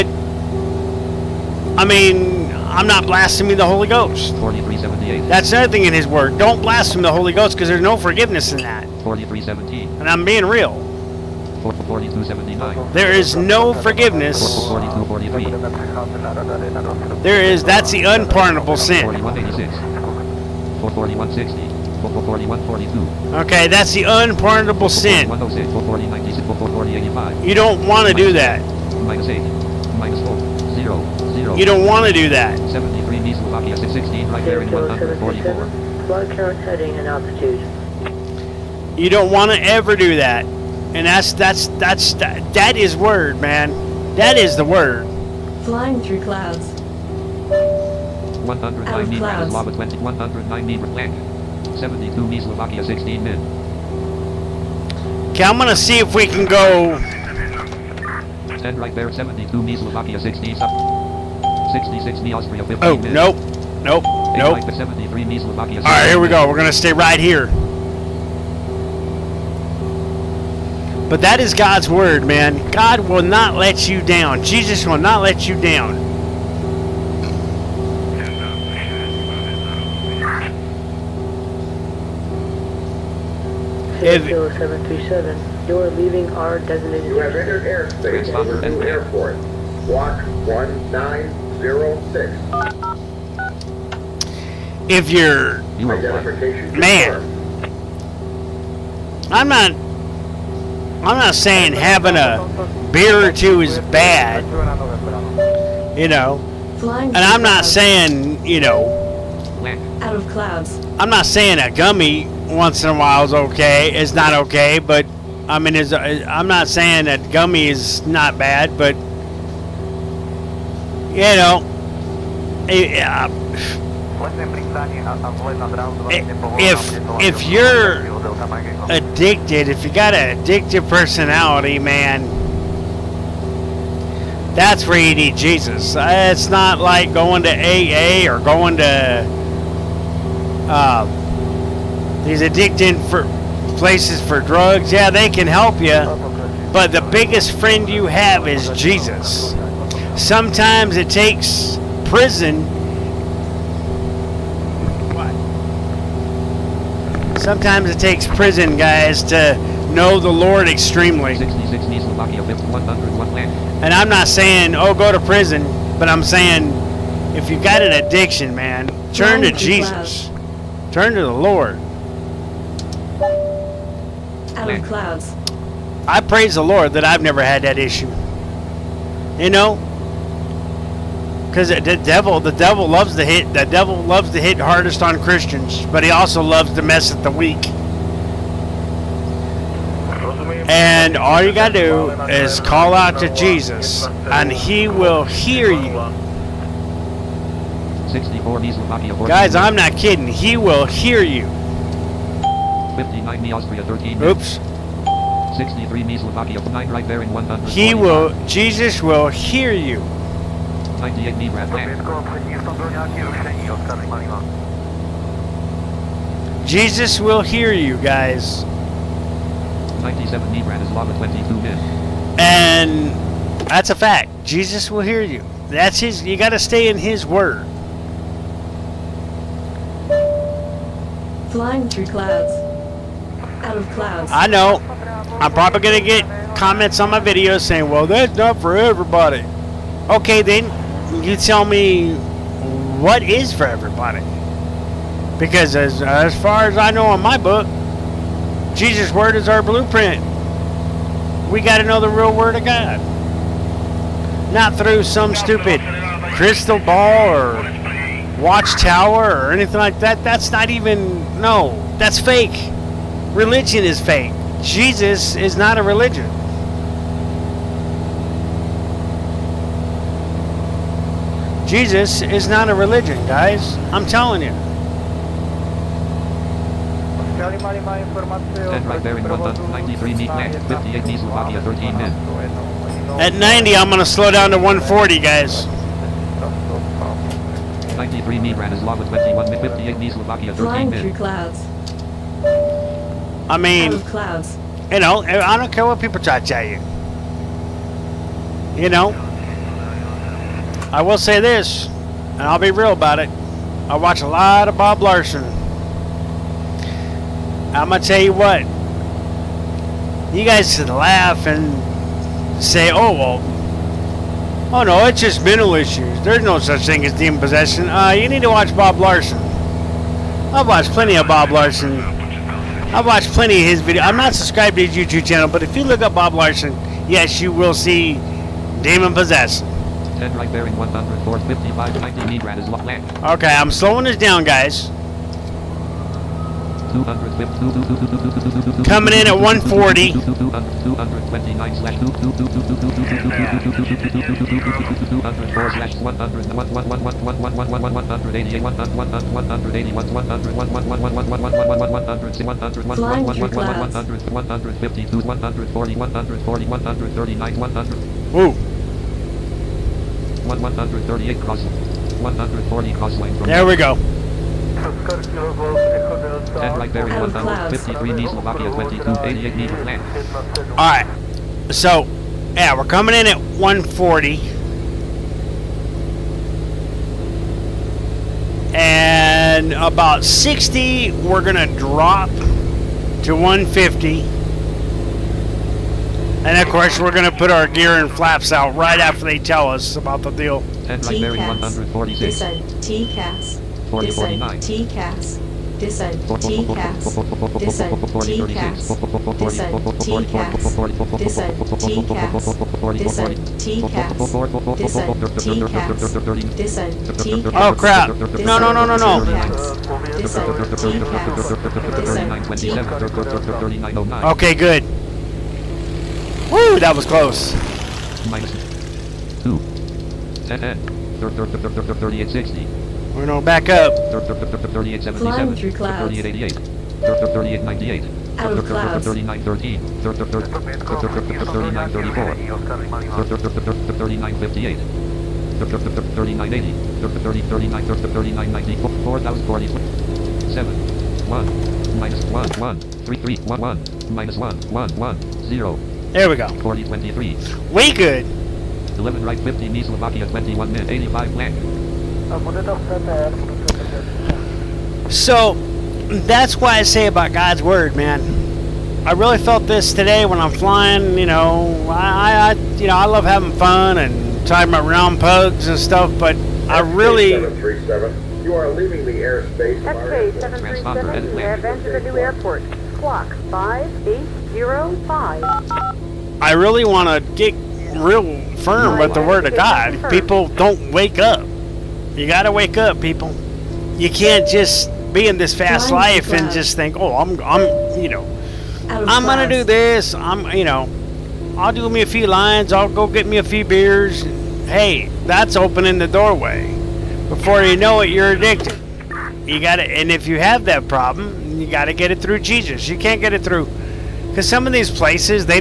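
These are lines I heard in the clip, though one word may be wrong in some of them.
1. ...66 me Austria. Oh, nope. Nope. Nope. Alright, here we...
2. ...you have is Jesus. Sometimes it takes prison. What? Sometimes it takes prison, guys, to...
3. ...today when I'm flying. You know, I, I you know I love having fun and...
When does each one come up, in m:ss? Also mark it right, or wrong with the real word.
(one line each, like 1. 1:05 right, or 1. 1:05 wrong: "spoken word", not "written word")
1. 1:01 right
2. 2:27 right
3. 7:39 right.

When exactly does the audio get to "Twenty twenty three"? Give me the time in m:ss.
7:26.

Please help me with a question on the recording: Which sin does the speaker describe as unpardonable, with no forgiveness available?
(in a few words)
Blaspheming the Holy Ghost.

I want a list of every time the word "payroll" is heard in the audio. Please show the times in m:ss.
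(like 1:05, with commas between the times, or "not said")
not said.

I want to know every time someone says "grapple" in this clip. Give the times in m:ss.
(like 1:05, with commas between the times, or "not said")
not said.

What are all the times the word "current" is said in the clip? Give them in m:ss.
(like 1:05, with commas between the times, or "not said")
0:36.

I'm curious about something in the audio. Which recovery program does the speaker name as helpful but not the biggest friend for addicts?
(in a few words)
AA.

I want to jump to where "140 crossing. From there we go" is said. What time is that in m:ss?
6:02.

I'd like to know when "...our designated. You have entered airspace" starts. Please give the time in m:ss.
1:26.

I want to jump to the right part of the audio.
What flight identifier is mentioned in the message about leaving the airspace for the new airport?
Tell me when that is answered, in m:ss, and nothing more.
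7:49.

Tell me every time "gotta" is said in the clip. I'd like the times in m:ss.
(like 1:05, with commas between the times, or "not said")
3:11, 3:46.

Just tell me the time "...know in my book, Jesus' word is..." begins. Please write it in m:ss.
4:06.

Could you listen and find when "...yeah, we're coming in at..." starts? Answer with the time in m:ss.
6:12.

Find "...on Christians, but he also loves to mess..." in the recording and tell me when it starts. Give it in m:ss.
3:05.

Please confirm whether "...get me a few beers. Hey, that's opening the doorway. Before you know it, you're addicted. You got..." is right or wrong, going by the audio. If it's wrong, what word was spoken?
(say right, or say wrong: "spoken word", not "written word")
right.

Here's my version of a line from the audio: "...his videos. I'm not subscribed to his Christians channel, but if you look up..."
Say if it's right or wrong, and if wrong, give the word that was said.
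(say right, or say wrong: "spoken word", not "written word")
wrong: "YouTube", not "Christians".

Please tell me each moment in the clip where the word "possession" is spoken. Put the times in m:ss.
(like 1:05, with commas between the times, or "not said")
5:17, 5:29.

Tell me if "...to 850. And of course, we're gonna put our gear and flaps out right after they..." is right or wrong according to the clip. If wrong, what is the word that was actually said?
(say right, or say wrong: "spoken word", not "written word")
wrong: "150", not "850".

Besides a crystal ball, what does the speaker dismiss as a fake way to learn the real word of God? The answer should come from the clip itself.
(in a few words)
Watchtower.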